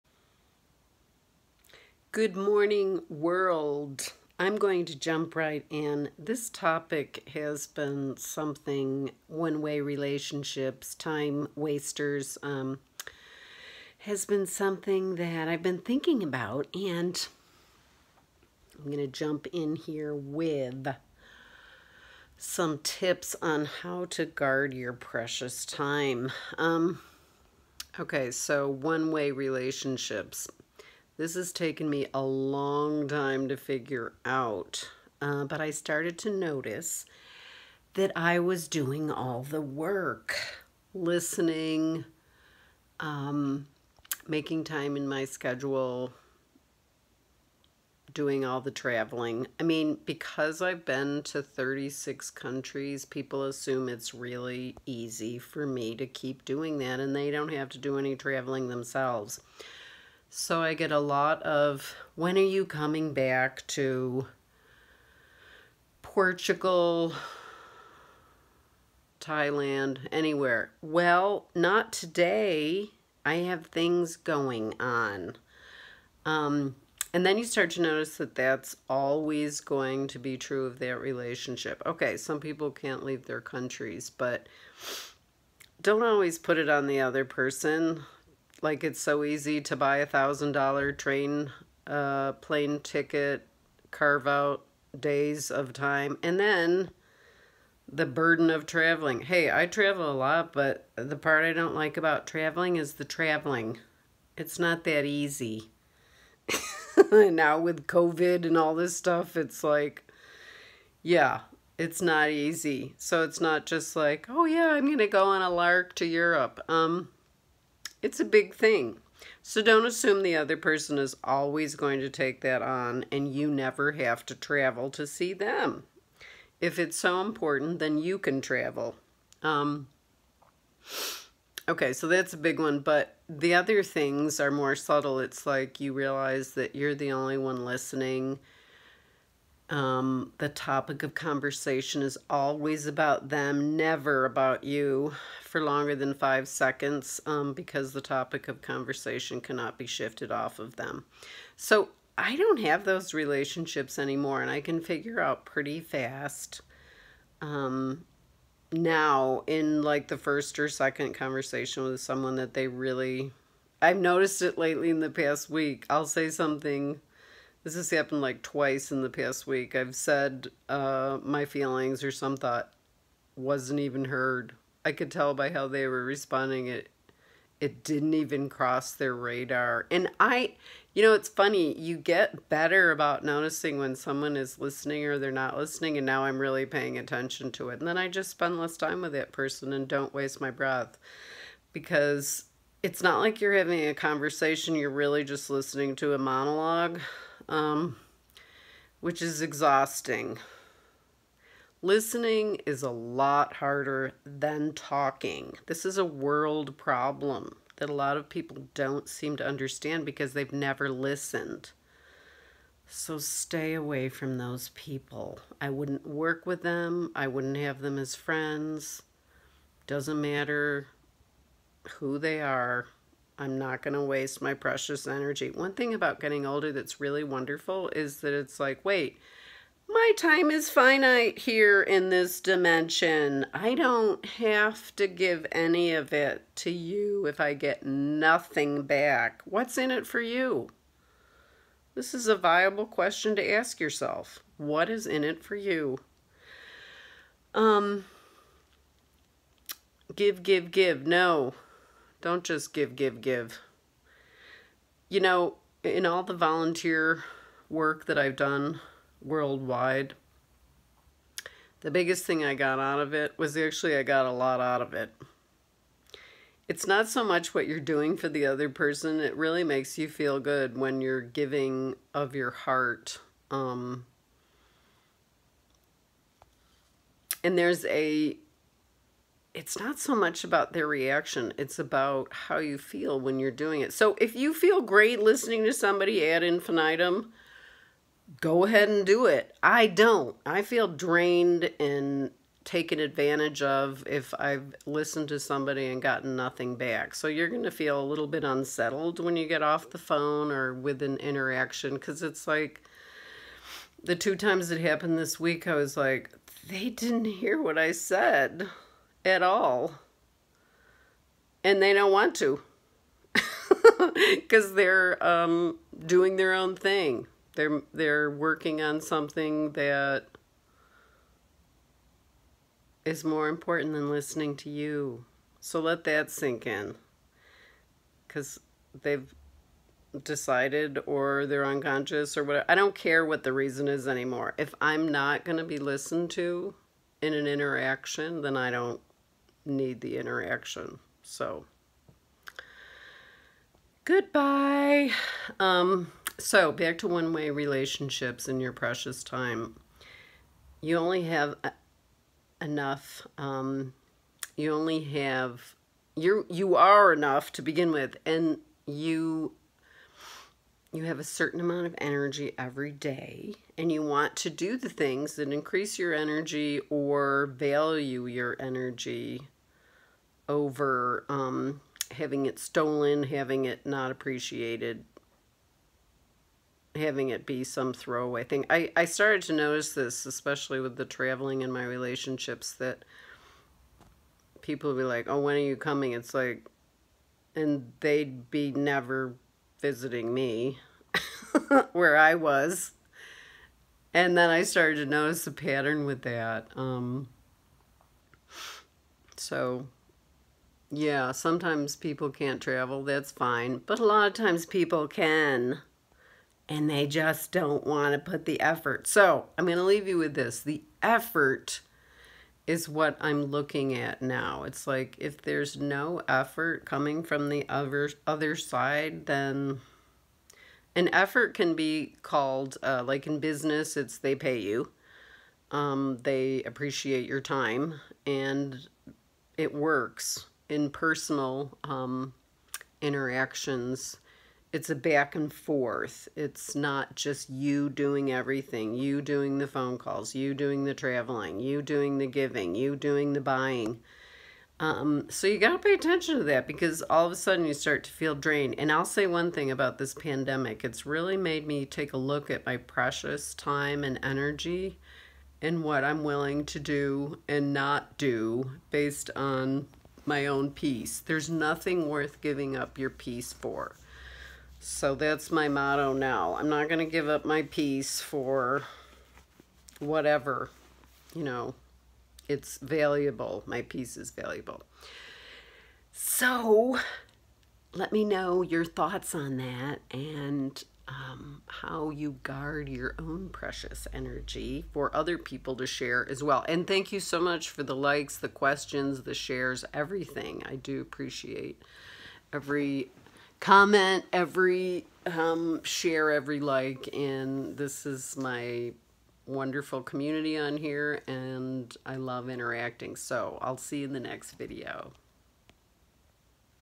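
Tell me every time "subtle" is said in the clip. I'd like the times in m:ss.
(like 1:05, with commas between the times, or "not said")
2:14.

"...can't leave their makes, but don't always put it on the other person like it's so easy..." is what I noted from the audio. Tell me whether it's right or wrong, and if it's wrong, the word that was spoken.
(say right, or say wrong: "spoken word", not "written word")
wrong: "countries", not "makes".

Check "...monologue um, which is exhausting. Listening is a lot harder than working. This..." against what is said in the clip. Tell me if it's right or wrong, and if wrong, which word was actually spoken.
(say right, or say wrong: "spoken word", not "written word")
wrong: "talking", not "working".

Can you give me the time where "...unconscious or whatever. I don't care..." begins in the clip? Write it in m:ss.
5:31.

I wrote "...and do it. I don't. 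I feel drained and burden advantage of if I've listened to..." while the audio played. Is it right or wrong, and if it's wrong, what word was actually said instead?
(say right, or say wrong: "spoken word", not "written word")
wrong: "taken", not "burden".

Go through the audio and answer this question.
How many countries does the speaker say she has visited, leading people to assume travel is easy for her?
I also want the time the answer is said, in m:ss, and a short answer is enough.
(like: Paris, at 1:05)
36, at 0:51.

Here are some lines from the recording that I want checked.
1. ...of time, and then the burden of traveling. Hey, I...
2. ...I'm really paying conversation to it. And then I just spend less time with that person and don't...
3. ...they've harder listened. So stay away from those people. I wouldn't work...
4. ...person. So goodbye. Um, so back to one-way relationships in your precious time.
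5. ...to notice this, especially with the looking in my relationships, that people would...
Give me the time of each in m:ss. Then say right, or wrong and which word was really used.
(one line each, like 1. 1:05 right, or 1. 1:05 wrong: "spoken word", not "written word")
1. 1:35 right
2. 3:06 wrong: "attention", not "conversation"
3. 3:30 wrong: "never", not "harder"
4. 5:40 wrong: "interaction", not "person"
5. 6:19 wrong: "traveling", not "looking".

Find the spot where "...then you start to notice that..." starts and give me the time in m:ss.
1:17.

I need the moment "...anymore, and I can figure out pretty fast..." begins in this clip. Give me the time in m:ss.
2:33.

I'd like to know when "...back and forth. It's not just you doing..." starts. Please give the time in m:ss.
7:14.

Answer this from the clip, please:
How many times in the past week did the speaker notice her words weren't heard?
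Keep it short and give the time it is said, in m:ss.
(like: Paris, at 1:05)
Twice, at 2:48.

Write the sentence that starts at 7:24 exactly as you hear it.
Um, so you got to pay attention to that because all of a sudden you start to feel drained.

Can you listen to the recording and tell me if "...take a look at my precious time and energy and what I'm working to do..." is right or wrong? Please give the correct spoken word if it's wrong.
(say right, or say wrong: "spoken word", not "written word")
wrong: "willing", not "working".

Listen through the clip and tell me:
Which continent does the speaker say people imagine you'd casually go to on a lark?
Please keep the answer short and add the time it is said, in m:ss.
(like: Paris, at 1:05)
Europe, at 1:56.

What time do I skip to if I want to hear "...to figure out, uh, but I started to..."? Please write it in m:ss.
0:33.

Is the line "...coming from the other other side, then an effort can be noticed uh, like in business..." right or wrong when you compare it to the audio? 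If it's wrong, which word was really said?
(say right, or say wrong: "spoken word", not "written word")
wrong: "called", not "noticed".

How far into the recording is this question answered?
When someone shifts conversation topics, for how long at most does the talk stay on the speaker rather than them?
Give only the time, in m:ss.
2:26.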